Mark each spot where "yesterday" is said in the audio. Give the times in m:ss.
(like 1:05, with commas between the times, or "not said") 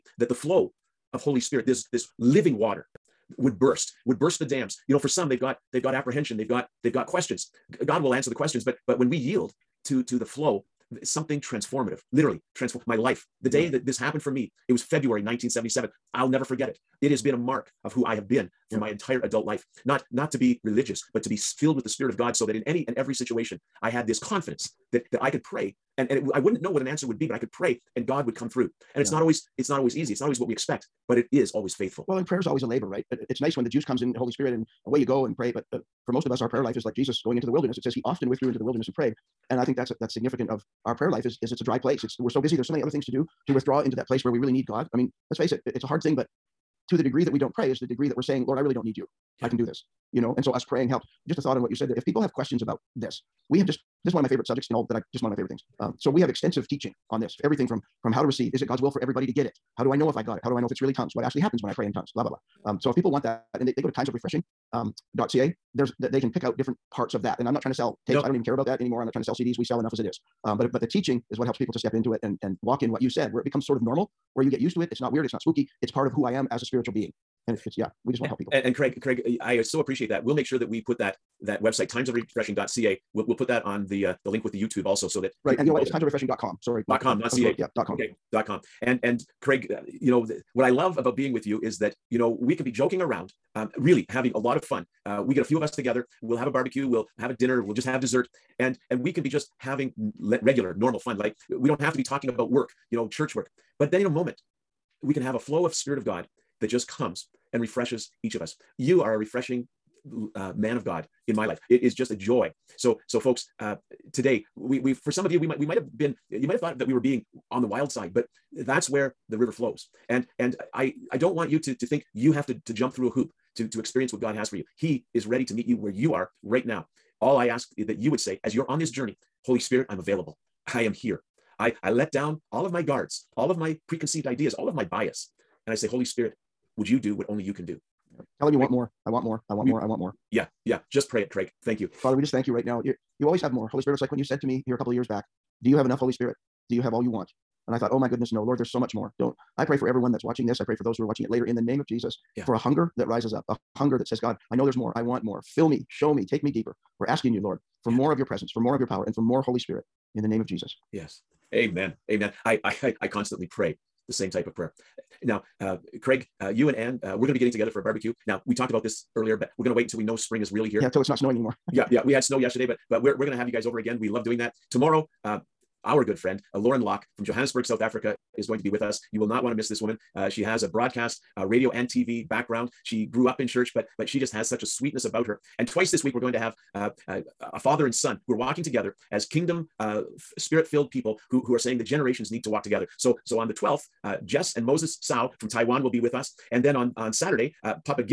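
2:52.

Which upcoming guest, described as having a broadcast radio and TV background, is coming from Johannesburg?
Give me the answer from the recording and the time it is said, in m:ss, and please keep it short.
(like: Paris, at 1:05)
Lauren Locke, at 2:56.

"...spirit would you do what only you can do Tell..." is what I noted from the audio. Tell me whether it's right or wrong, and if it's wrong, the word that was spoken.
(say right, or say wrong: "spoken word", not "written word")
right.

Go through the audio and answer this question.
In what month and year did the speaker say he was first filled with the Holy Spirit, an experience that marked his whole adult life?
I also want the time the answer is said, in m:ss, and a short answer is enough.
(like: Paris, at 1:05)
February 1977, at 0:14.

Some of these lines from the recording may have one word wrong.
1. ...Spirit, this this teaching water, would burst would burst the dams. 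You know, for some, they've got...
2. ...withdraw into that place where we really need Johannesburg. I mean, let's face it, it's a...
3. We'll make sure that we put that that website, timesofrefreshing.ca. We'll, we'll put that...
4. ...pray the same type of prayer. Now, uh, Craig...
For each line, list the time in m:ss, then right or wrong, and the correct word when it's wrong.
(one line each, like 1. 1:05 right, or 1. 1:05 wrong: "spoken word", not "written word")
1. 0:01 wrong: "living", not "teaching"
2. 0:43 wrong: "God", not "Johannesburg"
3. 1:20 right
4. 2:43 right.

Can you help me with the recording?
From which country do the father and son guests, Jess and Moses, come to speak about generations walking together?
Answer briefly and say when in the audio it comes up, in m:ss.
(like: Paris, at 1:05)
Taiwan, at 3:15.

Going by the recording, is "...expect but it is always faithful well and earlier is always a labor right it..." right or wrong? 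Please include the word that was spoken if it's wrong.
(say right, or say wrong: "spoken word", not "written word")
wrong: "prayer", not "earlier".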